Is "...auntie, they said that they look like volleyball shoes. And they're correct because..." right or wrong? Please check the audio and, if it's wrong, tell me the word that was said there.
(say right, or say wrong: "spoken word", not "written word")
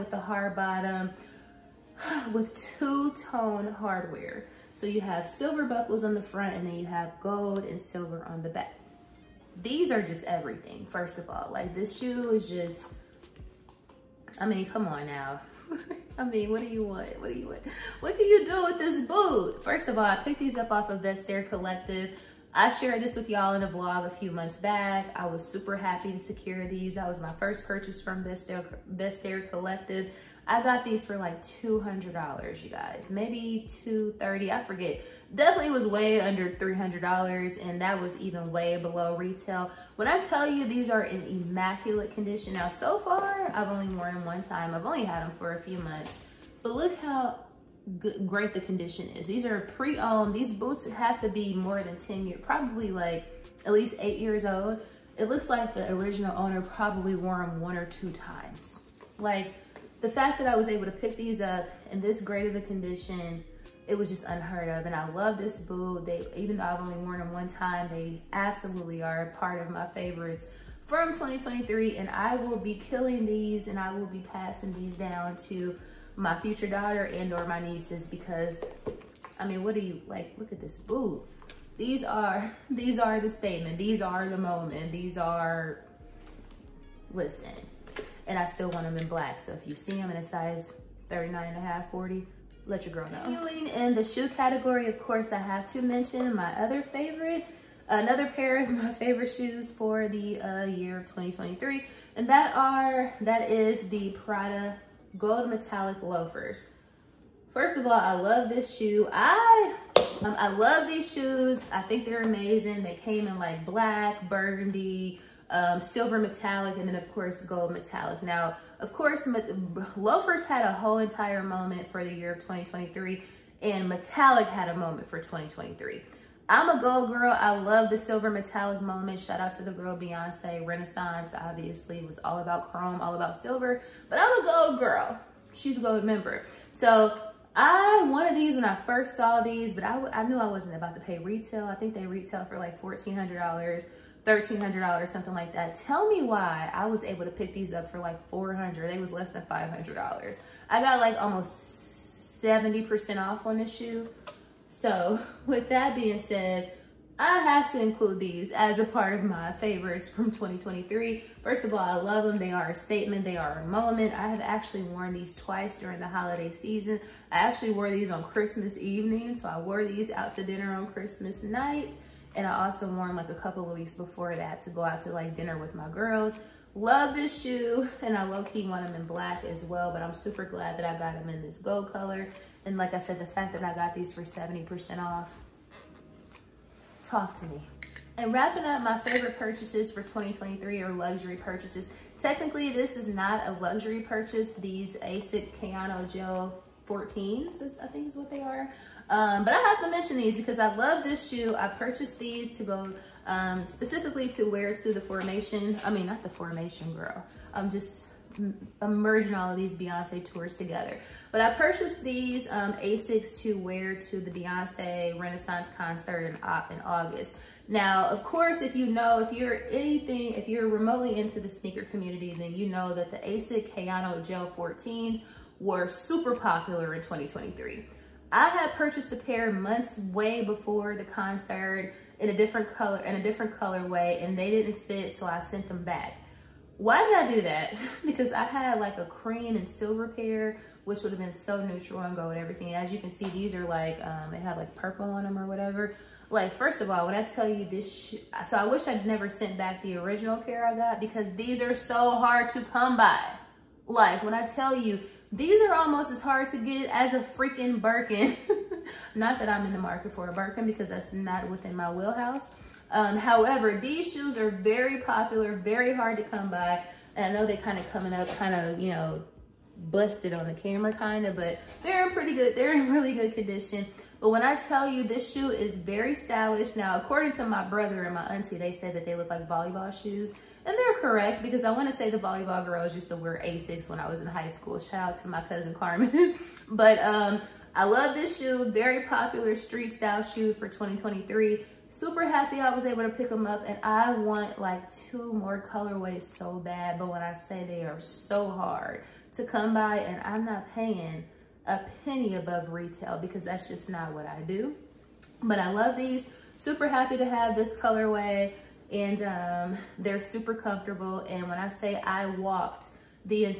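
right.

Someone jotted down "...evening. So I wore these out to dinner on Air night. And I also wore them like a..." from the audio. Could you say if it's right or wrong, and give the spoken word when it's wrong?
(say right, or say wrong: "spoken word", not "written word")
wrong: "Christmas", not "Air".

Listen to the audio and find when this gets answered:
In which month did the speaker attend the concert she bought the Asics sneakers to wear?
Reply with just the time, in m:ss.
3:36.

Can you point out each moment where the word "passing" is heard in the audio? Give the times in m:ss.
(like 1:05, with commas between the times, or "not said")
1:14.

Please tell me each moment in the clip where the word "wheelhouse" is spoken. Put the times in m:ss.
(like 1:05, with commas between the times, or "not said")
4:21.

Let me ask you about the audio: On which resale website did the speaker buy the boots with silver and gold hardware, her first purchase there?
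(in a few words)
Vestiaire Collective.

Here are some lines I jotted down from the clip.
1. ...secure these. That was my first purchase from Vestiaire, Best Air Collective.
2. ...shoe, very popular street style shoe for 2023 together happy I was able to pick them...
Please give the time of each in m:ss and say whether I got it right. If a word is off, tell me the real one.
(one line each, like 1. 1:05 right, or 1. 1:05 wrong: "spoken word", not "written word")
1. 0:26 right
2. 4:48 wrong: "super", not "together".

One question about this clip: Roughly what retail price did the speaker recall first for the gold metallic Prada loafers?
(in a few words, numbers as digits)
$1,400.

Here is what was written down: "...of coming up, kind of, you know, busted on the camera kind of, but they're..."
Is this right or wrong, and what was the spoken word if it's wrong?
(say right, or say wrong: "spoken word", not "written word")
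right.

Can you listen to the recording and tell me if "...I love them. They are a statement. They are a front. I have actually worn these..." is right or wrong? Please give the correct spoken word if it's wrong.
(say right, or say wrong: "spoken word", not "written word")
wrong: "moment", not "front".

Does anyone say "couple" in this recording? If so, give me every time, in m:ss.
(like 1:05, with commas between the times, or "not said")
2:53.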